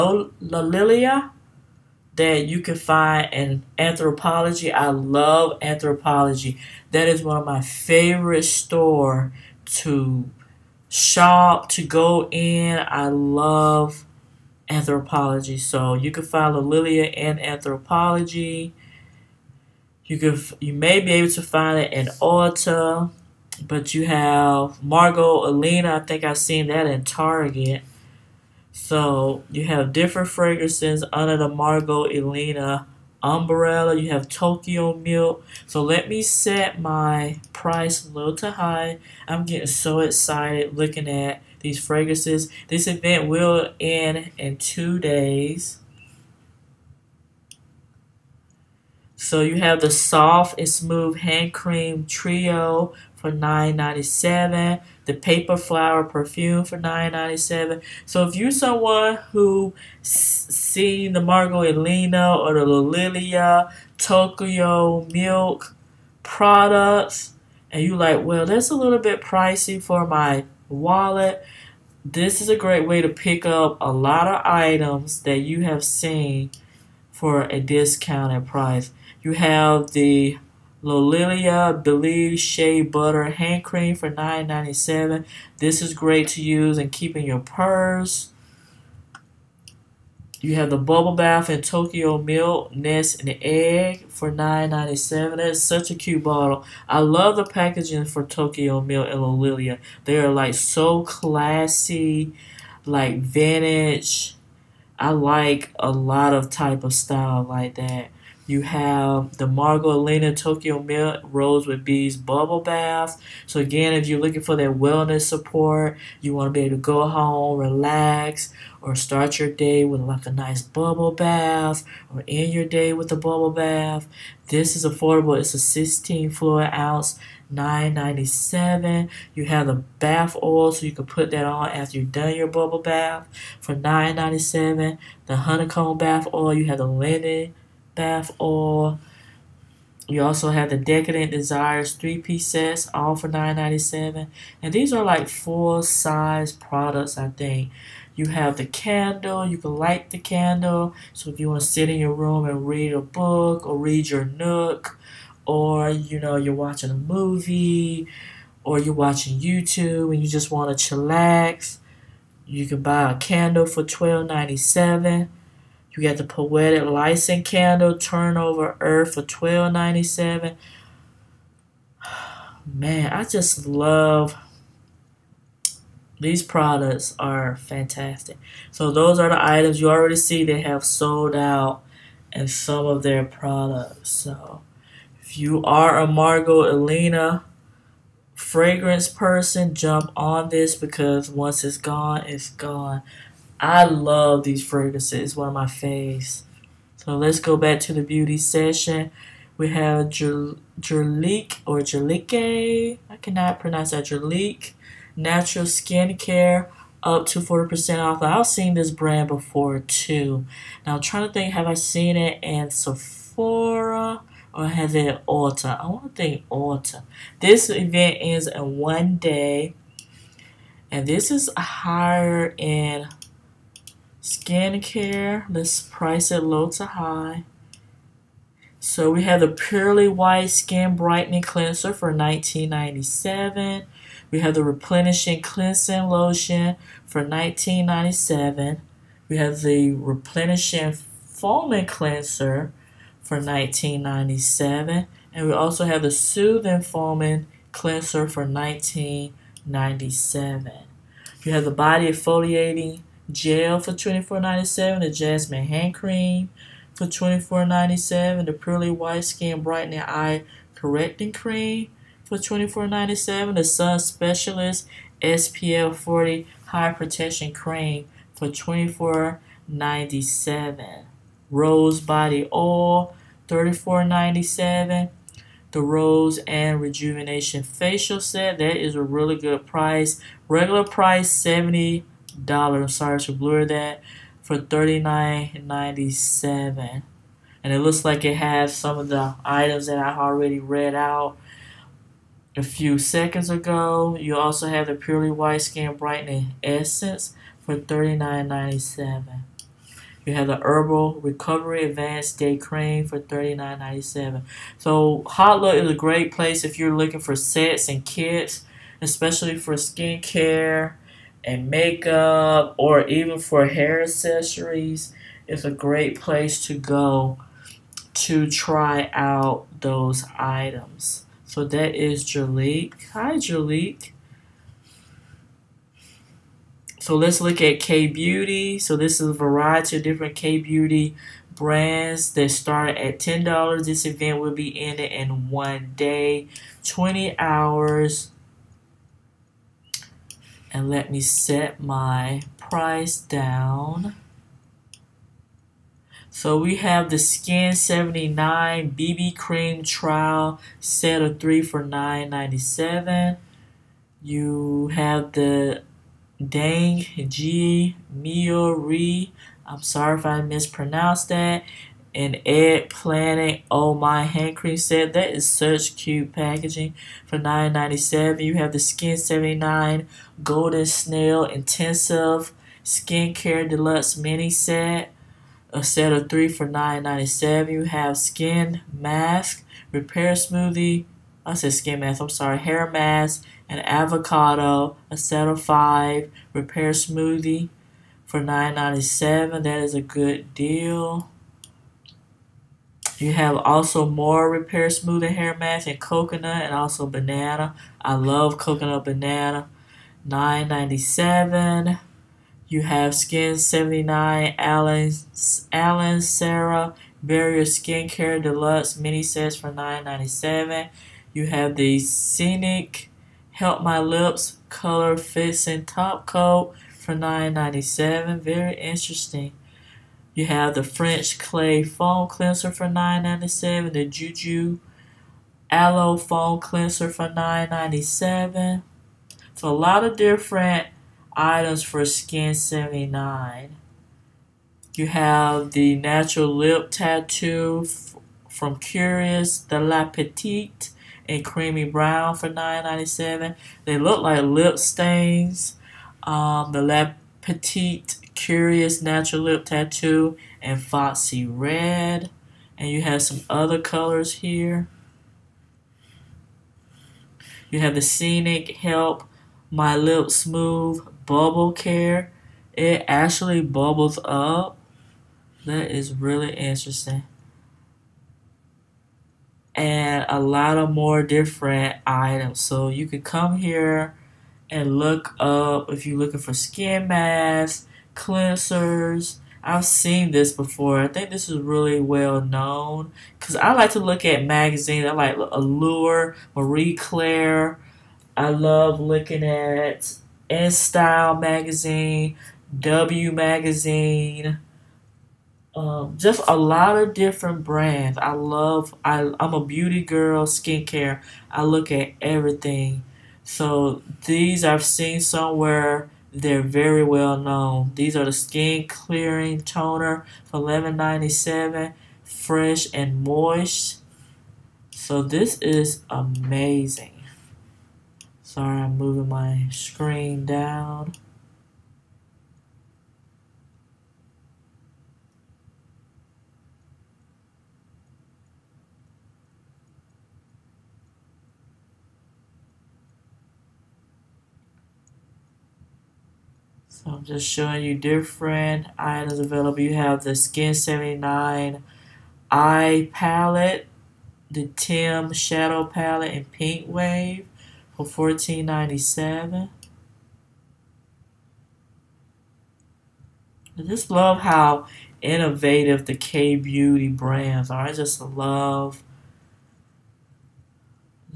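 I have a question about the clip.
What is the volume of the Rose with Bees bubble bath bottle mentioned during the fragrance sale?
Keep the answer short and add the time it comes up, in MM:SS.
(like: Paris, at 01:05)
16 fluid ounces, at 02:05.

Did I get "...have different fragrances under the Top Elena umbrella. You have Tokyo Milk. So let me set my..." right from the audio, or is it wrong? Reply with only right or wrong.
wrong.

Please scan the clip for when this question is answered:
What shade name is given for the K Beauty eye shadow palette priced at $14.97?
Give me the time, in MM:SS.
09:06.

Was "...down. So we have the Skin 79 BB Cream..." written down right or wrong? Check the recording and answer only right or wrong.
right.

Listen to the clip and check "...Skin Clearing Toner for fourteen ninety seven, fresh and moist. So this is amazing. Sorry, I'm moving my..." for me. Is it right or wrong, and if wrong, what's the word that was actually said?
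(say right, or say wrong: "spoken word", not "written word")
wrong: "eleven", not "fourteen".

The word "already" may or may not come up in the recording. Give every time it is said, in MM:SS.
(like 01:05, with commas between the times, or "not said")
02:59, 04:50.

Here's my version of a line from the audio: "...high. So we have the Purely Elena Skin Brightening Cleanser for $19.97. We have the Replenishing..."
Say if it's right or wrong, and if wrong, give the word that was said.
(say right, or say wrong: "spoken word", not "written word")
wrong: "White", not "Elena".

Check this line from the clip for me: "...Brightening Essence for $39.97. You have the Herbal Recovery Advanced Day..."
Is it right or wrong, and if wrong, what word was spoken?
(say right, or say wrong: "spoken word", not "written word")
right.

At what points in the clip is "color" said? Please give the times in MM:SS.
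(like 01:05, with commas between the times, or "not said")
06:54, 07:33.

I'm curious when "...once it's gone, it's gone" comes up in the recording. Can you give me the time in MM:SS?
03:11.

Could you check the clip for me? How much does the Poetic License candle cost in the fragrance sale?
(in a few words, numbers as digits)
$12.97.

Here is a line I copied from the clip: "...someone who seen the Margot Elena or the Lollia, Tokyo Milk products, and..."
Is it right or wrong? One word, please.
right.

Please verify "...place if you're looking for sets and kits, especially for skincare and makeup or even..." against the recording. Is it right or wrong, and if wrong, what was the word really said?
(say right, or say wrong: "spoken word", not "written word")
right.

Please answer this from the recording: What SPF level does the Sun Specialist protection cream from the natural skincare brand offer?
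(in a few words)
SPF 40.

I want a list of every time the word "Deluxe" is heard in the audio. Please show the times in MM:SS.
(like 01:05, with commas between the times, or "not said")
06:13, 06:48.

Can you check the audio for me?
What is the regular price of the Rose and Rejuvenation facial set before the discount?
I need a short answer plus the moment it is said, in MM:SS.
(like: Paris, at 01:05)
$70, at 04:41.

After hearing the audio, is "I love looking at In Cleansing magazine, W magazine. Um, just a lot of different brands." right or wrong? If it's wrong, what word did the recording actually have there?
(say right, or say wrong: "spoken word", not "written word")
wrong: "Style", not "Cleansing".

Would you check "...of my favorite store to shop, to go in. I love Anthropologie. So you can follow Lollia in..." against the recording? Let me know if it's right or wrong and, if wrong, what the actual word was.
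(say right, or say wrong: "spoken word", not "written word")
right.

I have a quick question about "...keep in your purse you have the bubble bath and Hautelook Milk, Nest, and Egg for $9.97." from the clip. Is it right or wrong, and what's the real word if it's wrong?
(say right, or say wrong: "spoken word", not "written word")
wrong: "Tokyo", not "Hautelook".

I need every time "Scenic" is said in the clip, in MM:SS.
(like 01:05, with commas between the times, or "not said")
06:51, 07:38.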